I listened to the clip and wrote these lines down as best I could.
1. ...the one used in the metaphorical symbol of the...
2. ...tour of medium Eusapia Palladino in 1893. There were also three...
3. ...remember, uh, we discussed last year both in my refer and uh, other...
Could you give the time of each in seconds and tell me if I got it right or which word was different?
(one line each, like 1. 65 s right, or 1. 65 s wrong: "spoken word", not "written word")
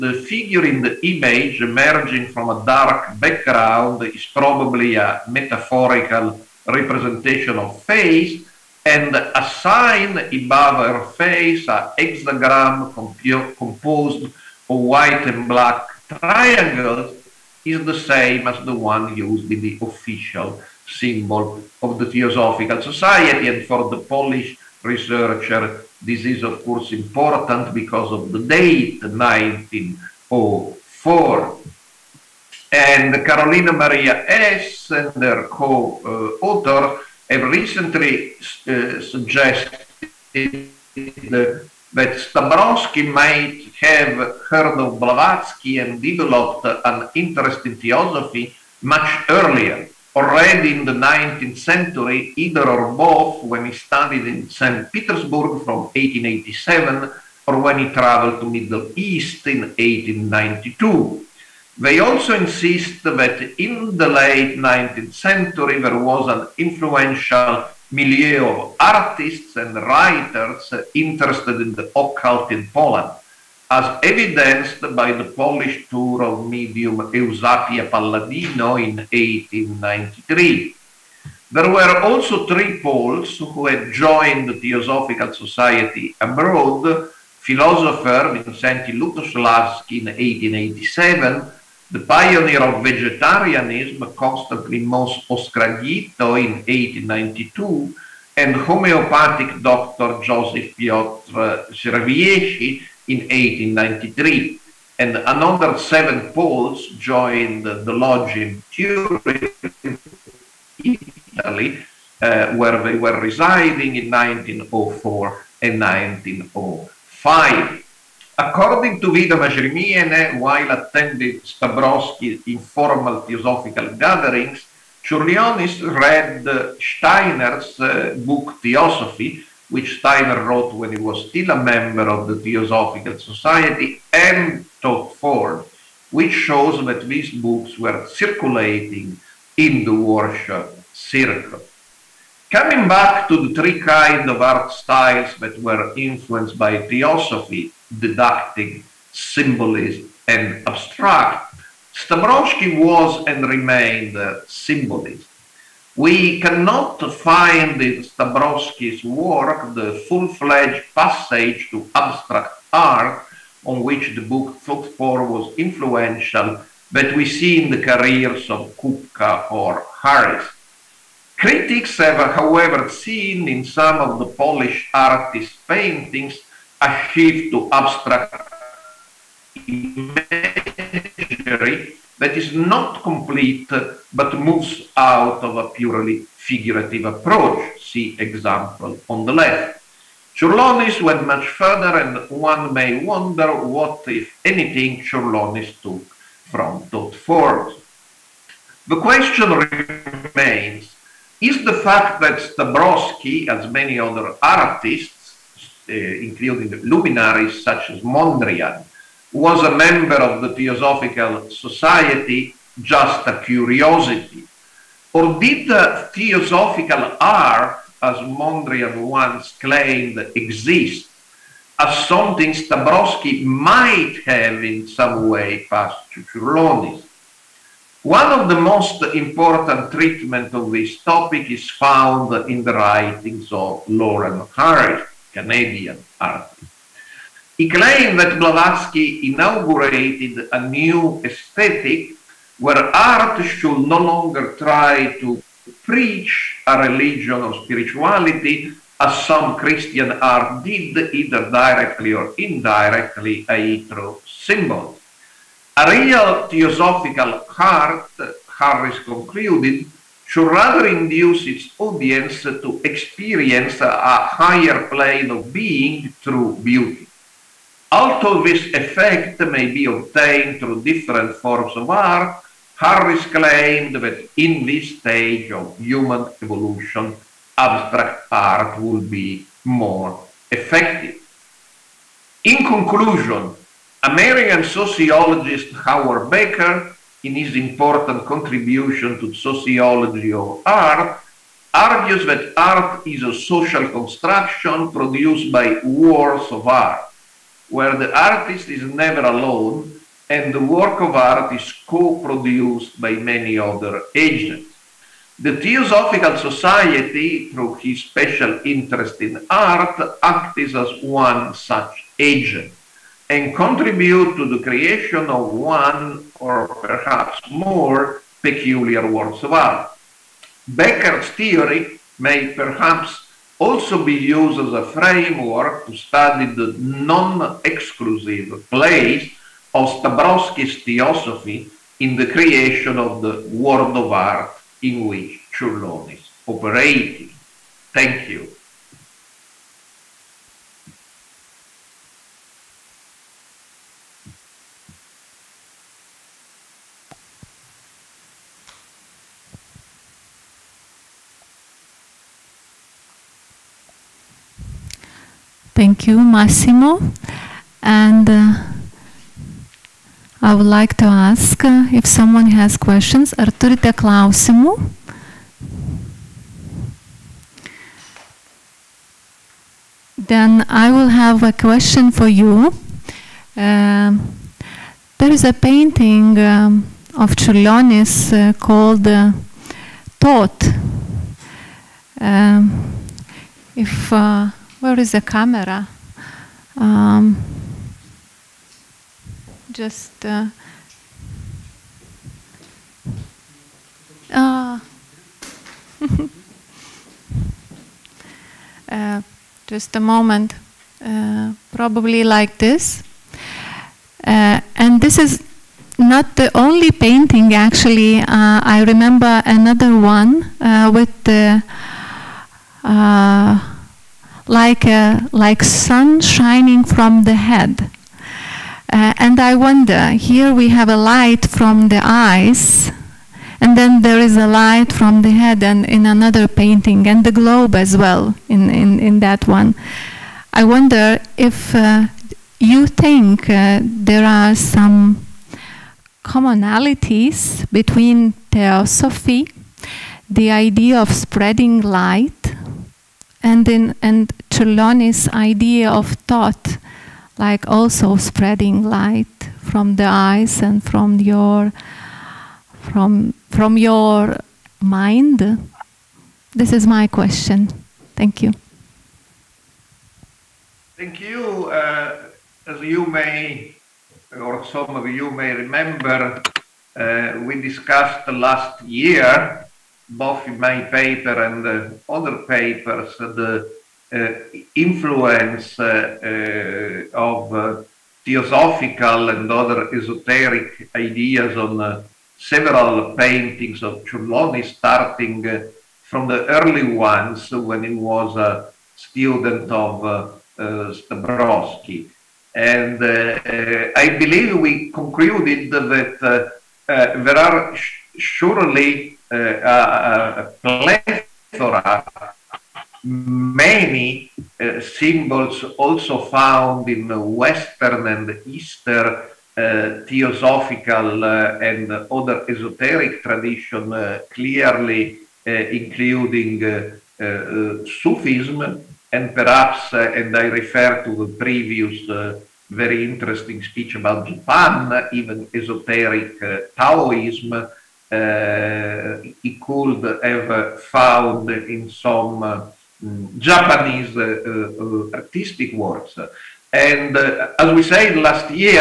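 1. 18 s wrong: "official", not "metaphorical"
2. 75 s right
3. 465 s wrong: "paper", not "refer".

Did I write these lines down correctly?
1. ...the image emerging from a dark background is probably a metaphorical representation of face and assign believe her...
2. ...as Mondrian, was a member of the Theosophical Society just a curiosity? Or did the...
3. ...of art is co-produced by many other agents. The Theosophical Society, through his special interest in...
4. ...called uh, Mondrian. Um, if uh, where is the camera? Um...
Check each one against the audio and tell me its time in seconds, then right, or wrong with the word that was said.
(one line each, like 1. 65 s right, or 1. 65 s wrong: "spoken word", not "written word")
1. 0 s wrong: "above", not "believe"
2. 207 s right
3. 300 s right
4. 378 s wrong: "Thought", not "Mondrian".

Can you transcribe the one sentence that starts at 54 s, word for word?
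Petersburg from 1887 or when he traveled to Middle East in 1892.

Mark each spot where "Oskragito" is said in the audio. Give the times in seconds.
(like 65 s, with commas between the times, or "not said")
95 s.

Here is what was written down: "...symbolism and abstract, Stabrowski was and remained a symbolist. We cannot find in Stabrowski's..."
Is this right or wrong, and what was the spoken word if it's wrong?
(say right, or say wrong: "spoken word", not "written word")
right.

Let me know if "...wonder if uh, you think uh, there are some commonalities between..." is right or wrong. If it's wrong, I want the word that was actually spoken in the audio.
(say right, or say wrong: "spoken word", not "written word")
right.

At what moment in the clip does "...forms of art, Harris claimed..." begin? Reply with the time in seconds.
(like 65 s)
271 s.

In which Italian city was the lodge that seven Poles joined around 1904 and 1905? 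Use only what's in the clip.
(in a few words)
Turin.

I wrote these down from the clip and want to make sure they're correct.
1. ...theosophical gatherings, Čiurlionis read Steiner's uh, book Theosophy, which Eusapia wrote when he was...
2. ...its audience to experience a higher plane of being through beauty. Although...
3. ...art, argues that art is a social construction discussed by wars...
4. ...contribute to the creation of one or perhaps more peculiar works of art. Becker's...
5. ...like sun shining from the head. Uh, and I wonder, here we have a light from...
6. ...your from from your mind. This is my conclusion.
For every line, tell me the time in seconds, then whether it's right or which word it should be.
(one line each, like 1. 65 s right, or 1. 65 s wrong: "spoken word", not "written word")
1. 123 s wrong: "Steiner", not "Eusapia"
2. 261 s right
3. 290 s wrong: "produced", not "discussed"
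4. 313 s right
5. 415 s right
6. 451 s wrong: "question", not "conclusion".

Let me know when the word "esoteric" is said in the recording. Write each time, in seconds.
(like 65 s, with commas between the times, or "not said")
479 s, 512 s, 525 s.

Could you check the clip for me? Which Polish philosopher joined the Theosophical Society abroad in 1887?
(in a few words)
Mikołaj Lutosławski.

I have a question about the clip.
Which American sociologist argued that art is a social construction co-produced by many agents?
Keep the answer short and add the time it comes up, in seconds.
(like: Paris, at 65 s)
Howard Becker, at 285 s.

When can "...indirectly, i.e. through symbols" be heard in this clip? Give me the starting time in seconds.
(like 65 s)
252 s.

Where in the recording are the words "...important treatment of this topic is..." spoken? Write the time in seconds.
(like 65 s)
229 s.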